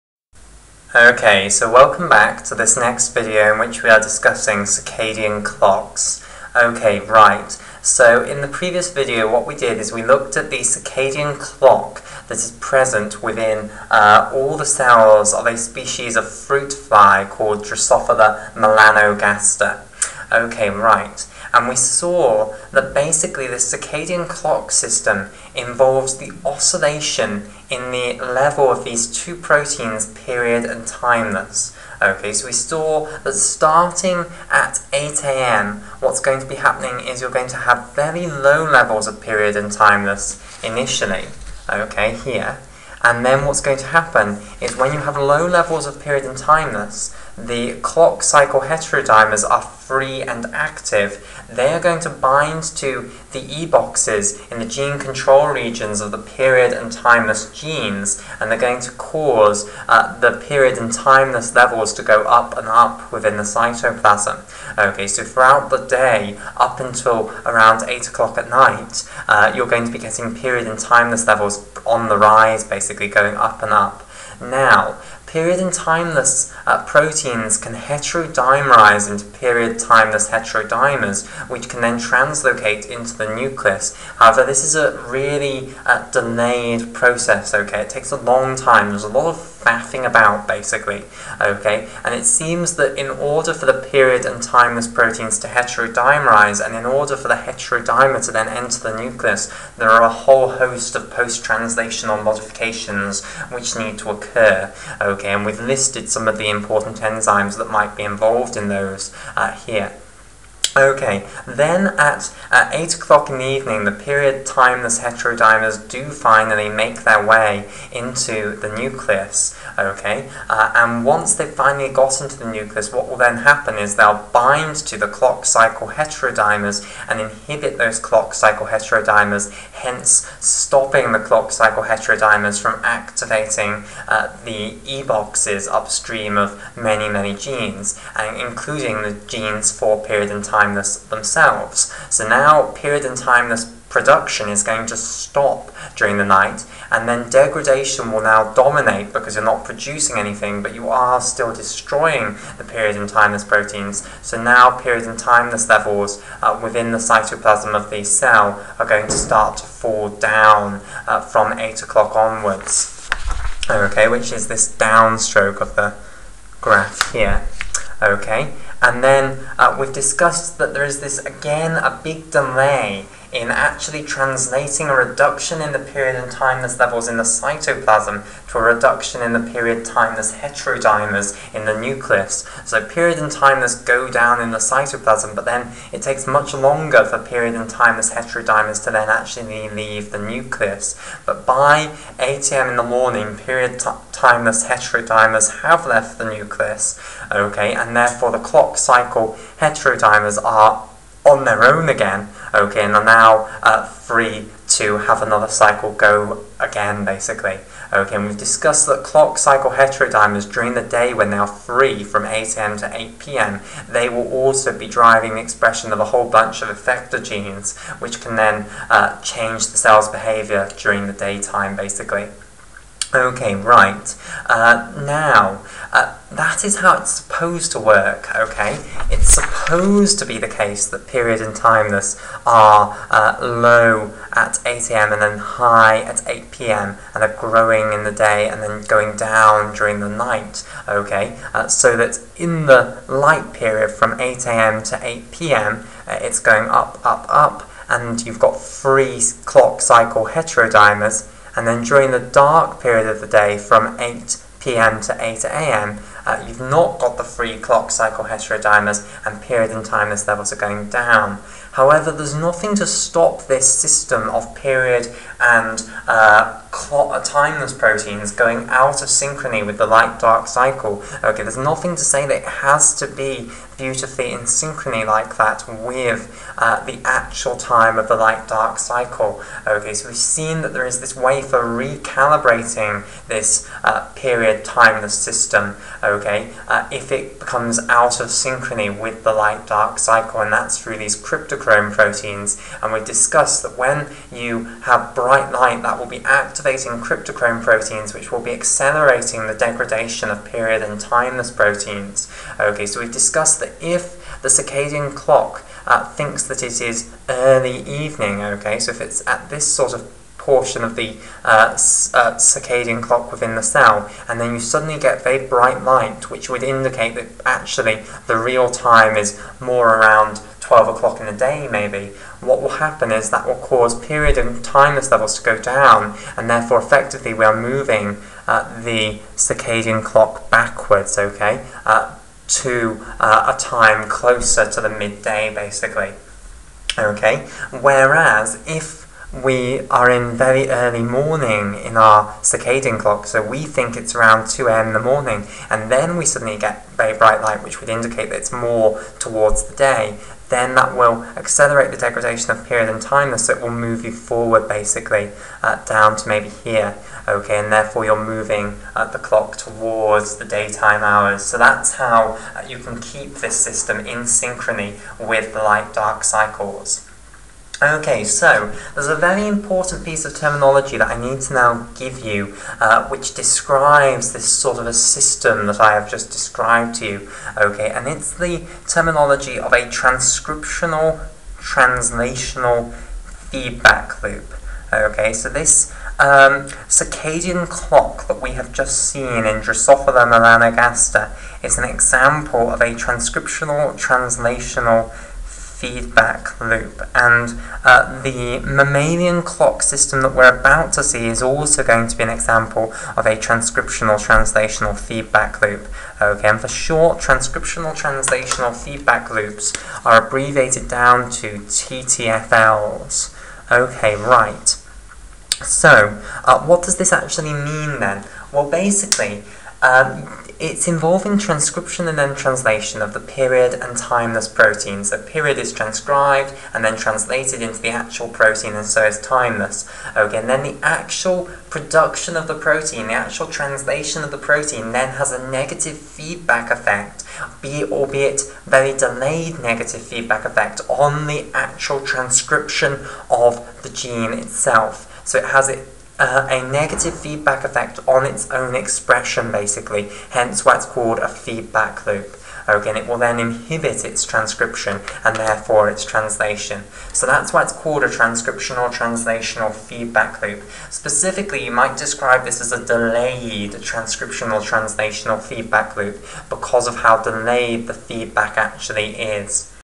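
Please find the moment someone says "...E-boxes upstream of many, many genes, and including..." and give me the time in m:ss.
2:14.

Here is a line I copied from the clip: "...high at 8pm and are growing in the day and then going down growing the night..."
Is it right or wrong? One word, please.
wrong.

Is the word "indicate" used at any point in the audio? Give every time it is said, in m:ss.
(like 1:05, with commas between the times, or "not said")
5:16, 5:47.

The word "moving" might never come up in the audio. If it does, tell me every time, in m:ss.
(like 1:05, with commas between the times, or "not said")
5:27, 5:58.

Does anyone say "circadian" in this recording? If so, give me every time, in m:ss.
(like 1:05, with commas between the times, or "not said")
0:04, 0:10, 0:23, 5:04, 5:12, 5:29, 5:42, 6:26.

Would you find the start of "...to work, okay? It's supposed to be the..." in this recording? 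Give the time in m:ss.
3:47.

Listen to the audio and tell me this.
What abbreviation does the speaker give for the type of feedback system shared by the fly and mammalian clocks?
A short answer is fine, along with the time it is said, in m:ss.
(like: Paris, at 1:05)
TTFLs, at 6:51.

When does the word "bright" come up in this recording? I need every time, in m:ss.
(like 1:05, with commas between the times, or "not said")
4:55, 5:15, 5:47.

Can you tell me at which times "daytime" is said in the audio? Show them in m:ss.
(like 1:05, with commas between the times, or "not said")
3:41, 6:00.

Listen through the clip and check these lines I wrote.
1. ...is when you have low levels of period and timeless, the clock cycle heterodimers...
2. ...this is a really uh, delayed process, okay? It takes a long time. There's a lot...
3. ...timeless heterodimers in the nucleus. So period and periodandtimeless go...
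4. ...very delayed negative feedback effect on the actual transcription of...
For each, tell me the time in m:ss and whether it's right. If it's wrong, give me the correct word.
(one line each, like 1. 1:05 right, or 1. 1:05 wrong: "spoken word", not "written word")
1. 0:44 right
2. 1:24 right
3. 2:59 wrong: "timeless", not "periodandtimeless"
4. 7:18 right.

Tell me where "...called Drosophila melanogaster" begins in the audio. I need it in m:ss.
0:17.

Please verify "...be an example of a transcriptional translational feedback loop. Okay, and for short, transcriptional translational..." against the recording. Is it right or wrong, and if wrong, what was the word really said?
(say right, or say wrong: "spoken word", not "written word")
right.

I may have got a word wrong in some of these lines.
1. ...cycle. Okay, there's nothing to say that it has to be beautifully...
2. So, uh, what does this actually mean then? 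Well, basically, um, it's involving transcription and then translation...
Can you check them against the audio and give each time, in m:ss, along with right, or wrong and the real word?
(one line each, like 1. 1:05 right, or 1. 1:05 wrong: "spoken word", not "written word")
1. 4:30 right
2. 6:55 right.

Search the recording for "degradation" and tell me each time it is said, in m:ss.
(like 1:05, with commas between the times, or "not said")
2:27, 4:59, 5:51.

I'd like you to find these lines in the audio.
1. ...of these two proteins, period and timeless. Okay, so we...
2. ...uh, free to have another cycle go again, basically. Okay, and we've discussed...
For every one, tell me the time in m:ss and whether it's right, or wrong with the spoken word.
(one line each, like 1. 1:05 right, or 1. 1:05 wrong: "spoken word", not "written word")
1. 0:28 right
2. 3:23 right.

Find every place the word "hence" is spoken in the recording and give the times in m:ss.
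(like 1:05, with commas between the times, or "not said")
2:09, 7:30.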